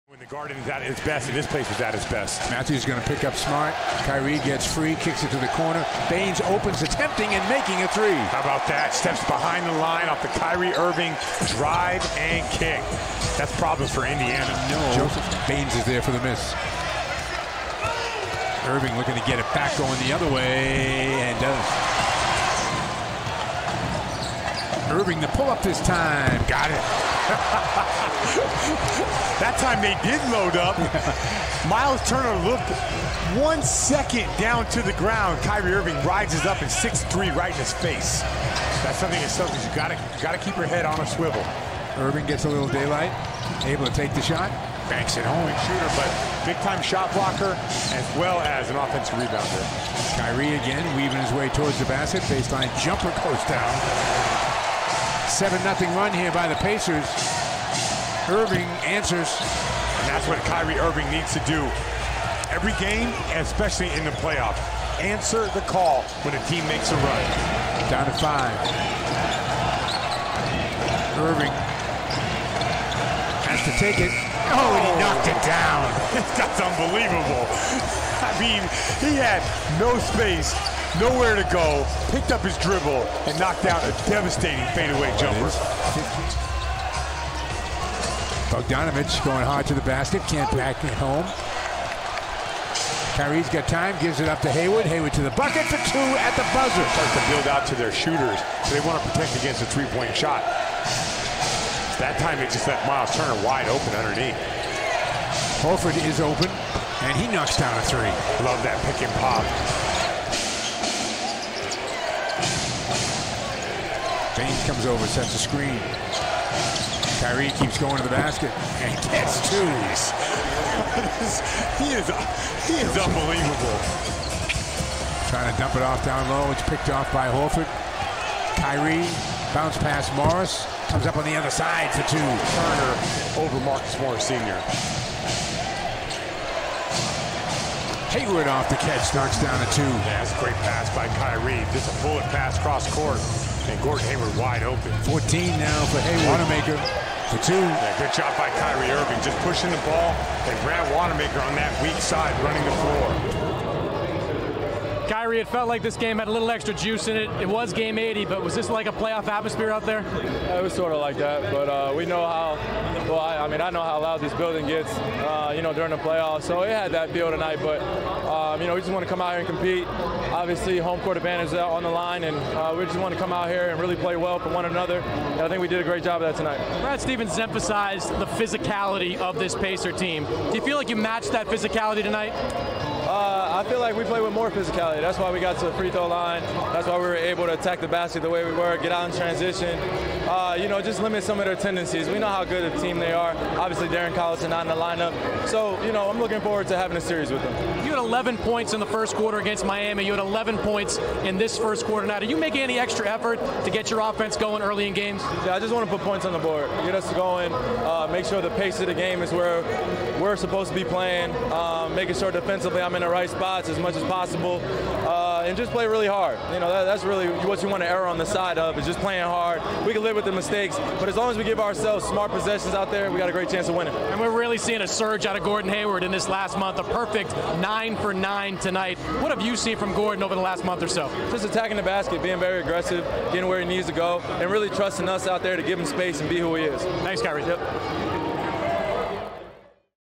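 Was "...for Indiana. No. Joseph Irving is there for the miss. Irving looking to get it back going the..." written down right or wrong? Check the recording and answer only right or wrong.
wrong.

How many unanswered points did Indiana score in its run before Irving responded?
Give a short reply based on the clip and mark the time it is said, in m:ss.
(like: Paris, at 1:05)
7, at 0:55.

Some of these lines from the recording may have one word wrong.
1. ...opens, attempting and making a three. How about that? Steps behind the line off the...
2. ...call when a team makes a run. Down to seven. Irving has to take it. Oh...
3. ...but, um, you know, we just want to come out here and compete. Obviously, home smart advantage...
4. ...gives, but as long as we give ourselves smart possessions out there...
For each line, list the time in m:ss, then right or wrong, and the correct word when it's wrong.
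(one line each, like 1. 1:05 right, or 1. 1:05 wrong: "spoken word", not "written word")
1. 0:06 right
2. 1:05 wrong: "five", not "seven"
3. 2:47 wrong: "court", not "smart"
4. 3:40 wrong: "mistakes", not "gives".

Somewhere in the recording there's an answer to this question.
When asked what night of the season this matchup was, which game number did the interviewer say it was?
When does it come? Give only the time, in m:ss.
2:37.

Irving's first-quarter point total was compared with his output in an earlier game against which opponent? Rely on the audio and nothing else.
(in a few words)
Miami.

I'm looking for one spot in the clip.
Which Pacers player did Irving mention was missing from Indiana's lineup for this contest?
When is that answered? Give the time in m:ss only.
3:13.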